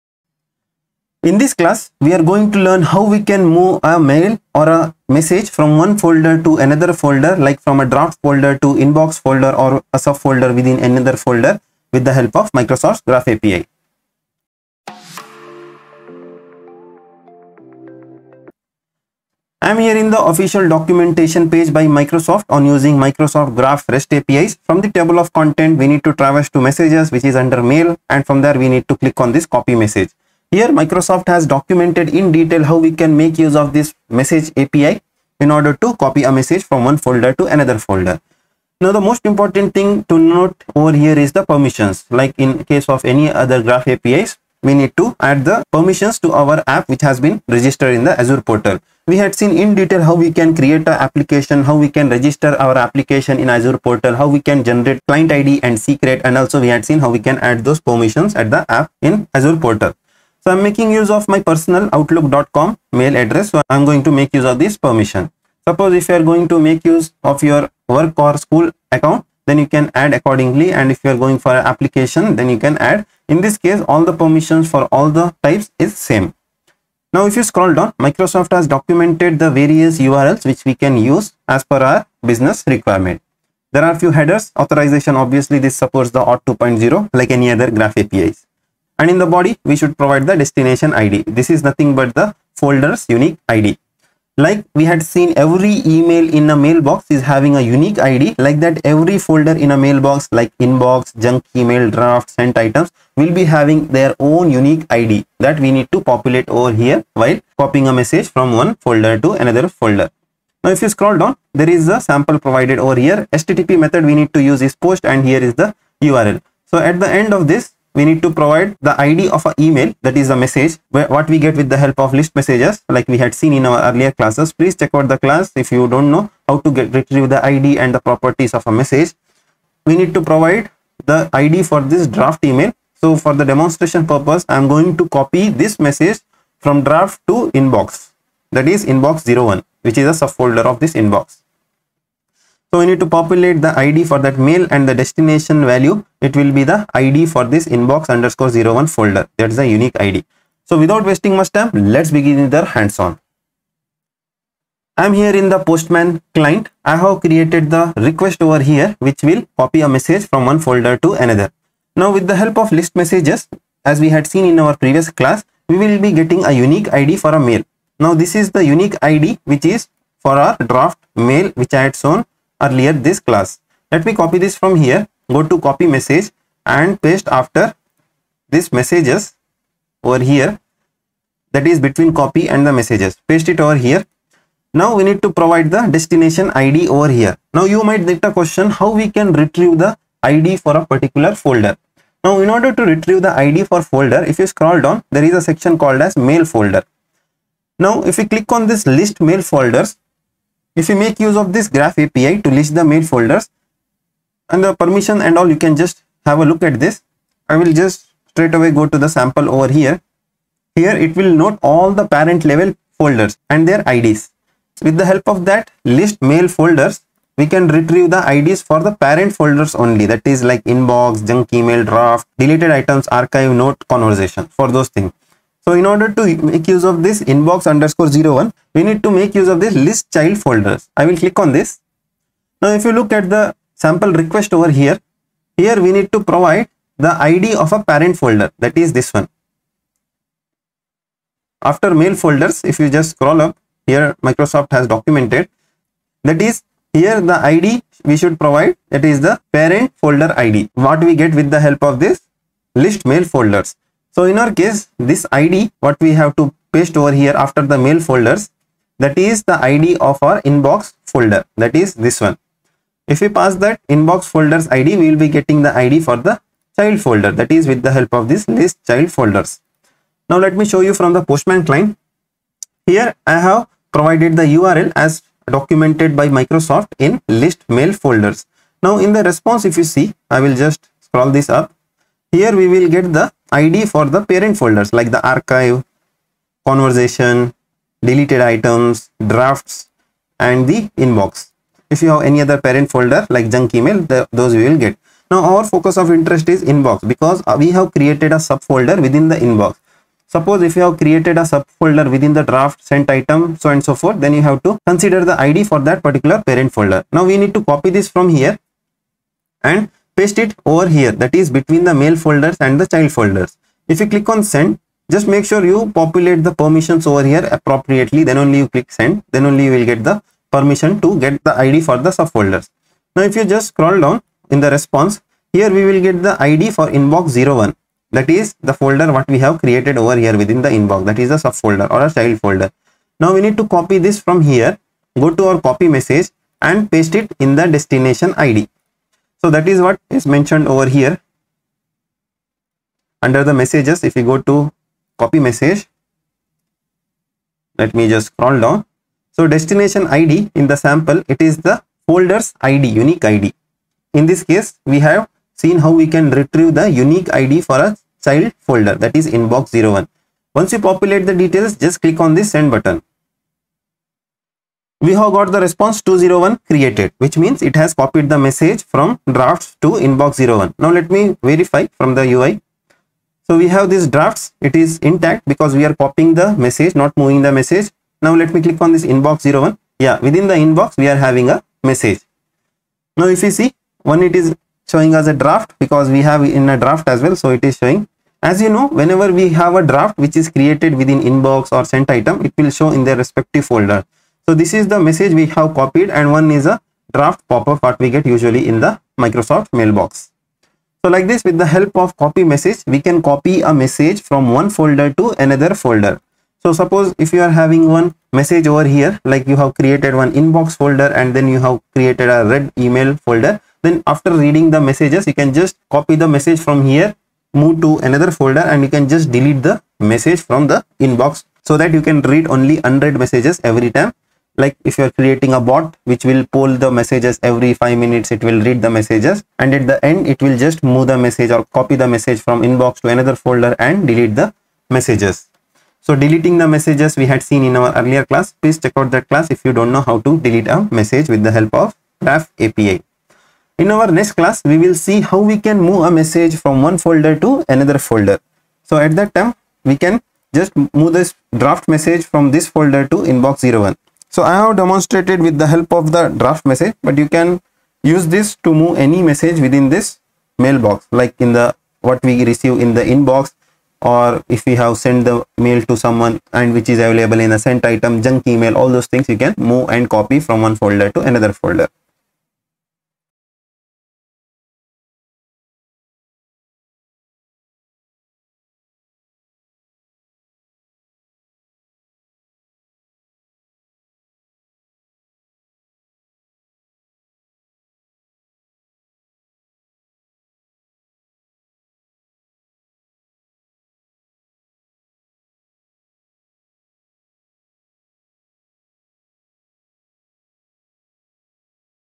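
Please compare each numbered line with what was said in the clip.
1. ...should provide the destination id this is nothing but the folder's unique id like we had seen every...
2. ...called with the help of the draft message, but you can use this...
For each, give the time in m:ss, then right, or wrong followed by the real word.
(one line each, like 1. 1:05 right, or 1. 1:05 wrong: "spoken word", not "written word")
1. 1:29 right
2. 7:34 wrong: "demonstrated", not "called".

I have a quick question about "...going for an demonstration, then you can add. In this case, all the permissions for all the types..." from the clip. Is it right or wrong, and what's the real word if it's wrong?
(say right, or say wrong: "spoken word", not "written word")
wrong: "application", not "demonstration".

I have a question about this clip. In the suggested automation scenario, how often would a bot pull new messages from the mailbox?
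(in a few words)
every five minutes.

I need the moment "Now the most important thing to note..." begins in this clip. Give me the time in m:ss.
0:38.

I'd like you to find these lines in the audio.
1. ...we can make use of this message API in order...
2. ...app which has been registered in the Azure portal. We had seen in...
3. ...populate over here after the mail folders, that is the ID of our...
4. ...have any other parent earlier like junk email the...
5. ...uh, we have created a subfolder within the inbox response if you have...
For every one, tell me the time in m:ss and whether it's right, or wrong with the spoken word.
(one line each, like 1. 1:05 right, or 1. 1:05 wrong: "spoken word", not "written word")
1. 0:32 right
2. 0:46 right
3. 4:16 wrong: "paste", not "populate"
4. 4:52 wrong: "folder", not "earlier"
5. 4:57 wrong: "suppose", not "response".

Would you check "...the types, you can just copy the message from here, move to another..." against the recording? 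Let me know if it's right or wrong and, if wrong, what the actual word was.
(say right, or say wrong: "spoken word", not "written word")
wrong: "messages", not "types".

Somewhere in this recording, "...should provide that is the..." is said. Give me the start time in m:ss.
4:08.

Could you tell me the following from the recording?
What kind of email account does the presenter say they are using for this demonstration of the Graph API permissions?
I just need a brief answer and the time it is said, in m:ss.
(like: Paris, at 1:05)
personal outlook.com, at 1:01.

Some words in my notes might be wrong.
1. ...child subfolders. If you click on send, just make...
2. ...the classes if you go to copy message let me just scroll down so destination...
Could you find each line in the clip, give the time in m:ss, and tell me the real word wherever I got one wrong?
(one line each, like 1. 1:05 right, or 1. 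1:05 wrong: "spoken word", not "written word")
1. 5:12 wrong: "folders", not "subfolders"
2. 5:43 wrong: "messages", not "classes".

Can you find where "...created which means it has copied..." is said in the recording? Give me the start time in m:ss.
6:06.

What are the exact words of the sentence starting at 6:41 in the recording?
So like this with the help of copy message, we can copy a message from one folder to another folder.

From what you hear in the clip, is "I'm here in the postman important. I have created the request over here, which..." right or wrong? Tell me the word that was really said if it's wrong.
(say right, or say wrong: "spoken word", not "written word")
wrong: "client", not "important".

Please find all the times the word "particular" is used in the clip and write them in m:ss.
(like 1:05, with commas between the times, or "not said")
3:10, 5:06.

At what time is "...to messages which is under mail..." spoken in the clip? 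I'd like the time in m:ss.
0:26.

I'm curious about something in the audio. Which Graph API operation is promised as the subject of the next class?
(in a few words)
move a message.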